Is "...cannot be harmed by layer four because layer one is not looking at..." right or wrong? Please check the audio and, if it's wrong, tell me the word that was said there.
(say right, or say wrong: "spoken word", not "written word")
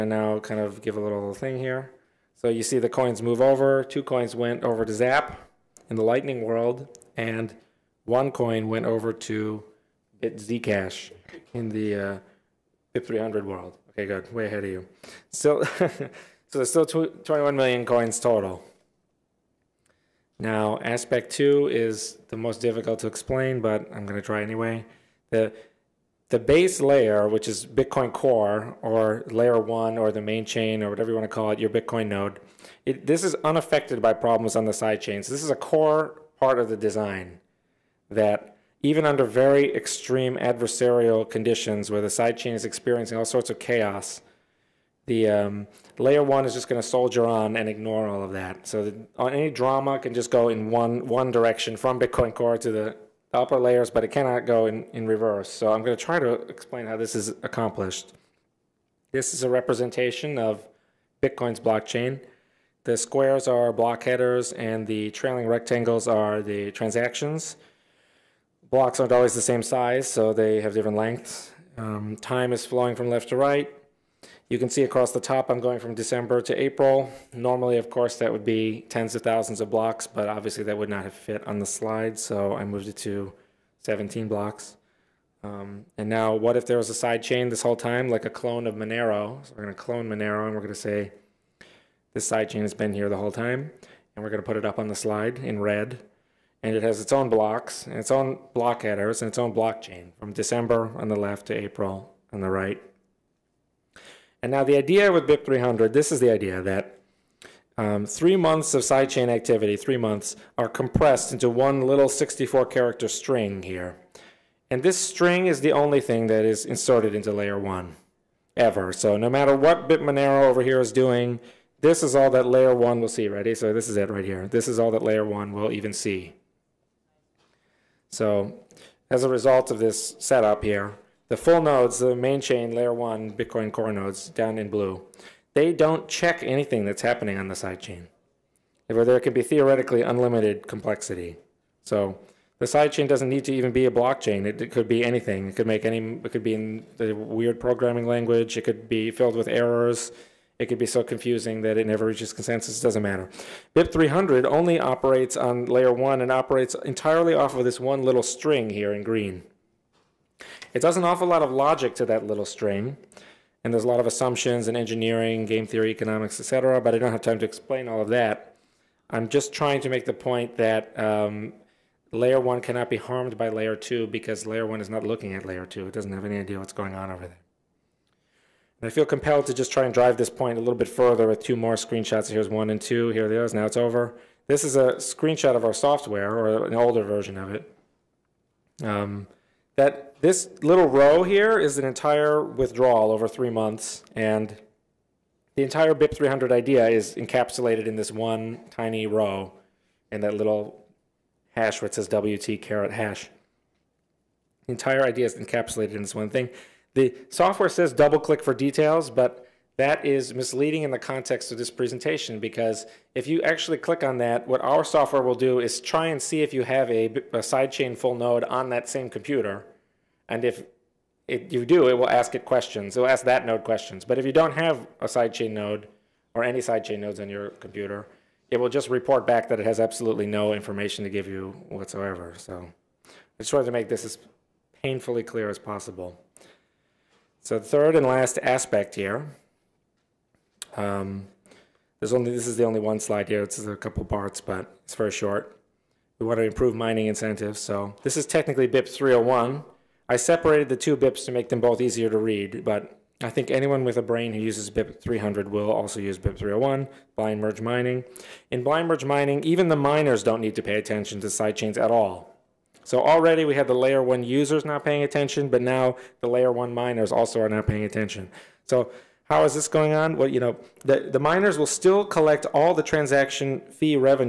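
wrong: "two", not "four".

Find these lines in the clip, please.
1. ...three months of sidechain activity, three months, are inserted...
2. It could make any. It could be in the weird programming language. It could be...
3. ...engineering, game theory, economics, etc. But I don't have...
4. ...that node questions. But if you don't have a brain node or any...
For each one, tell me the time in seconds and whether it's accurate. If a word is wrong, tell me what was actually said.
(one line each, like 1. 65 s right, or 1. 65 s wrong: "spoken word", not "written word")
1. 108 s wrong: "compressed", not "inserted"
2. 145 s right
3. 164 s right
4. 223 s wrong: "sidechain", not "brain".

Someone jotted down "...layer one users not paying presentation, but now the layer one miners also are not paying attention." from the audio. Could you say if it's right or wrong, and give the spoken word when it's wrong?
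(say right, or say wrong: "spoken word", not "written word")
wrong: "attention", not "presentation".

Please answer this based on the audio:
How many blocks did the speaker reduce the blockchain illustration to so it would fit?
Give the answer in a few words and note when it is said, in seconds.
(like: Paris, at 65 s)
17, at 83 s.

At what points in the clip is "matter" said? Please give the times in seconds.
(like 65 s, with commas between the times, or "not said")
119 s, 153 s.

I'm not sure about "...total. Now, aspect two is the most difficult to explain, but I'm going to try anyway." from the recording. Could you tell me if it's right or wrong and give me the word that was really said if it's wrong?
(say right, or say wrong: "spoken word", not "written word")
right.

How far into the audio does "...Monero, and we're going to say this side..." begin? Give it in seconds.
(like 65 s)
90 s.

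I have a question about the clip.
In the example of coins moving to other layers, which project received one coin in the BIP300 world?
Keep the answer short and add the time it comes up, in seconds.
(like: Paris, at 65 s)
Zcash, at 10 s.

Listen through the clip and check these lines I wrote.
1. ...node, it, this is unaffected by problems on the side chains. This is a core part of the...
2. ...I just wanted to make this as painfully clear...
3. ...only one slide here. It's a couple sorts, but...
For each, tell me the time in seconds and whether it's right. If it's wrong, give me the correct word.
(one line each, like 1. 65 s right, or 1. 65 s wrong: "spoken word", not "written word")
1. 32 s right
2. 233 s right
3. 242 s wrong: "parts", not "sorts".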